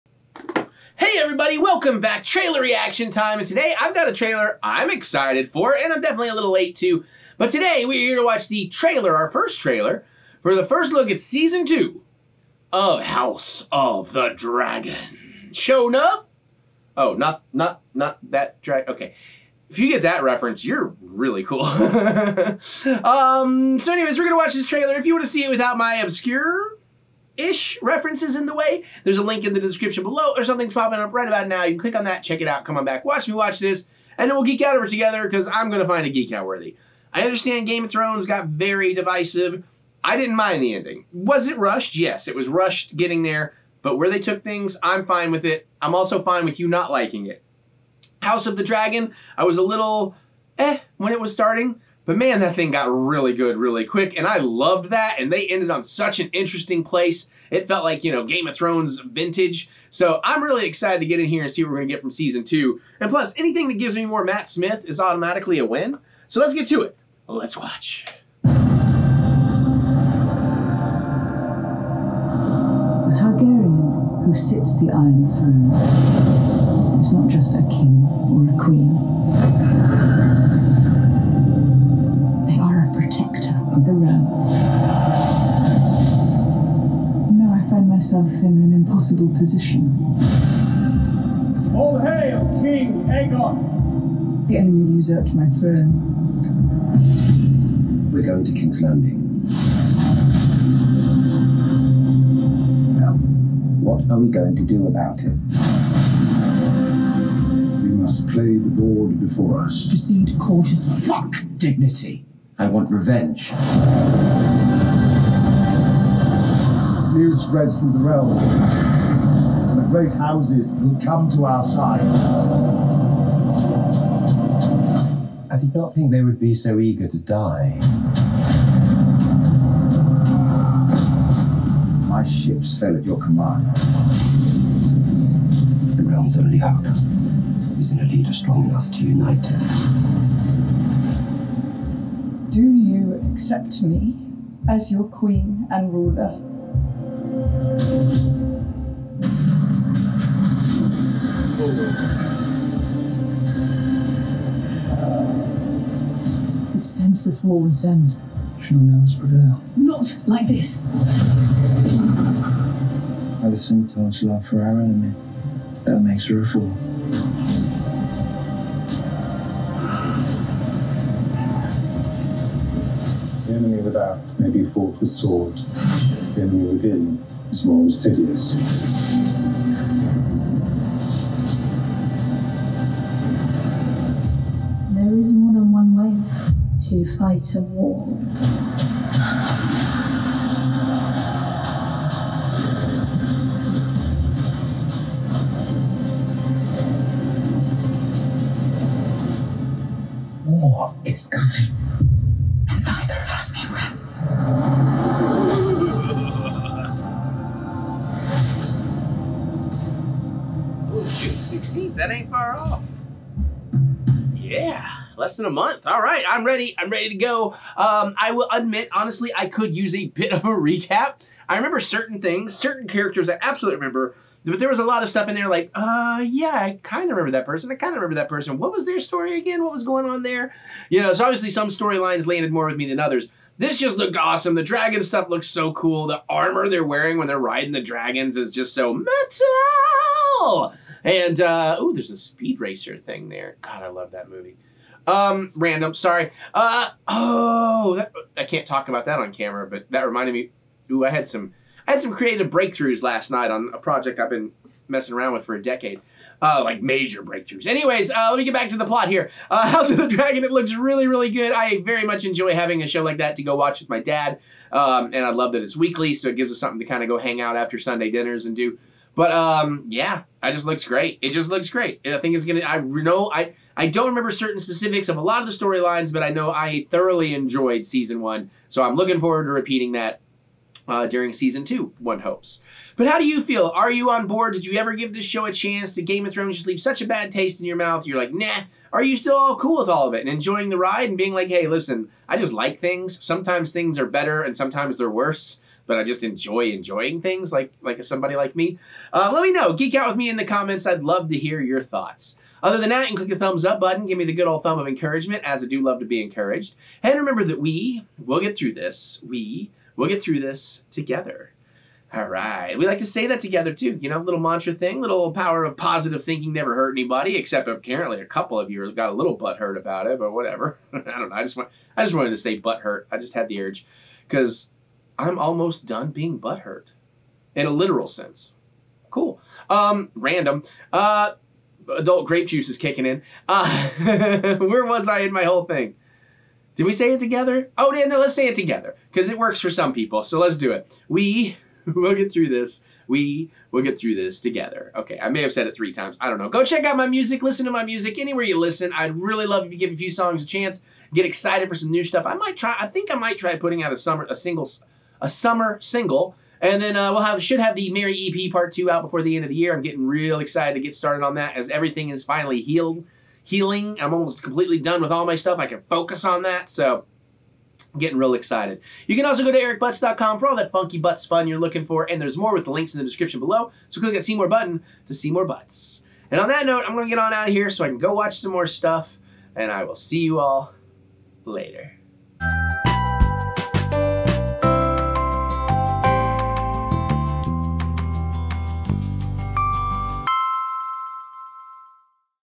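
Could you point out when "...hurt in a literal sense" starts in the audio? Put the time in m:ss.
5:26.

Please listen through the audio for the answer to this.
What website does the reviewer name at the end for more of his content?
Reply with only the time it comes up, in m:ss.
6:09.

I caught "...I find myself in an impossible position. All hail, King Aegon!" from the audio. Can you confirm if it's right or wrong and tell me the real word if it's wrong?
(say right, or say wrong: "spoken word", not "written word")
right.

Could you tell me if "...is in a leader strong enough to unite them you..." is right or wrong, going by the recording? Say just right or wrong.
right.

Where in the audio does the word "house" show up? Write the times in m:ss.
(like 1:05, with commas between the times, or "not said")
0:13, 0:48, 2:00, 4:19.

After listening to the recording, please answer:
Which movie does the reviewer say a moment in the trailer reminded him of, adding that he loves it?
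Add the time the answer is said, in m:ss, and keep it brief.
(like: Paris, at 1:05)
Speed Racer, at 4:02.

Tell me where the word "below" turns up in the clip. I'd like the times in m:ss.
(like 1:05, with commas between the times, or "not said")
0:30, 6:13.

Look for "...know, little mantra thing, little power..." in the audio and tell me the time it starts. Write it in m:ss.
5:14.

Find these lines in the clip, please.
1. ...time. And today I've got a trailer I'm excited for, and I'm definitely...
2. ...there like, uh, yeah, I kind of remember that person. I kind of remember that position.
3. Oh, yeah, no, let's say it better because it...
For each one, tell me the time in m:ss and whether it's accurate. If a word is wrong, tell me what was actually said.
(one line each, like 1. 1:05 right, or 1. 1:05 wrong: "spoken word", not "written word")
1. 0:03 right
2. 3:45 wrong: "person", not "position"
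3. 5:37 wrong: "together", not "better".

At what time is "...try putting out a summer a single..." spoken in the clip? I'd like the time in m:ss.
5:53.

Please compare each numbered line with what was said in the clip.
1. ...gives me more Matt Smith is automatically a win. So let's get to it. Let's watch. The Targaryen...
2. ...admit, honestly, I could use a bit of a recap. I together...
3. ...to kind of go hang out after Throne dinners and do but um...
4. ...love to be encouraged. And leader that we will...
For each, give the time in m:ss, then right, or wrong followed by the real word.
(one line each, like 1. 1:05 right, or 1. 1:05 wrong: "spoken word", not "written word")
1. 1:03 right
2. 3:38 wrong: "remember", not "together"
3. 4:26 wrong: "Sunday", not "Throne"
4. 5:05 wrong: "remember", not "leader".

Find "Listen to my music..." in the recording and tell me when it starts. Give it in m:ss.
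5:47.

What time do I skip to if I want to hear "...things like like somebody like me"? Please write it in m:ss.
4:57.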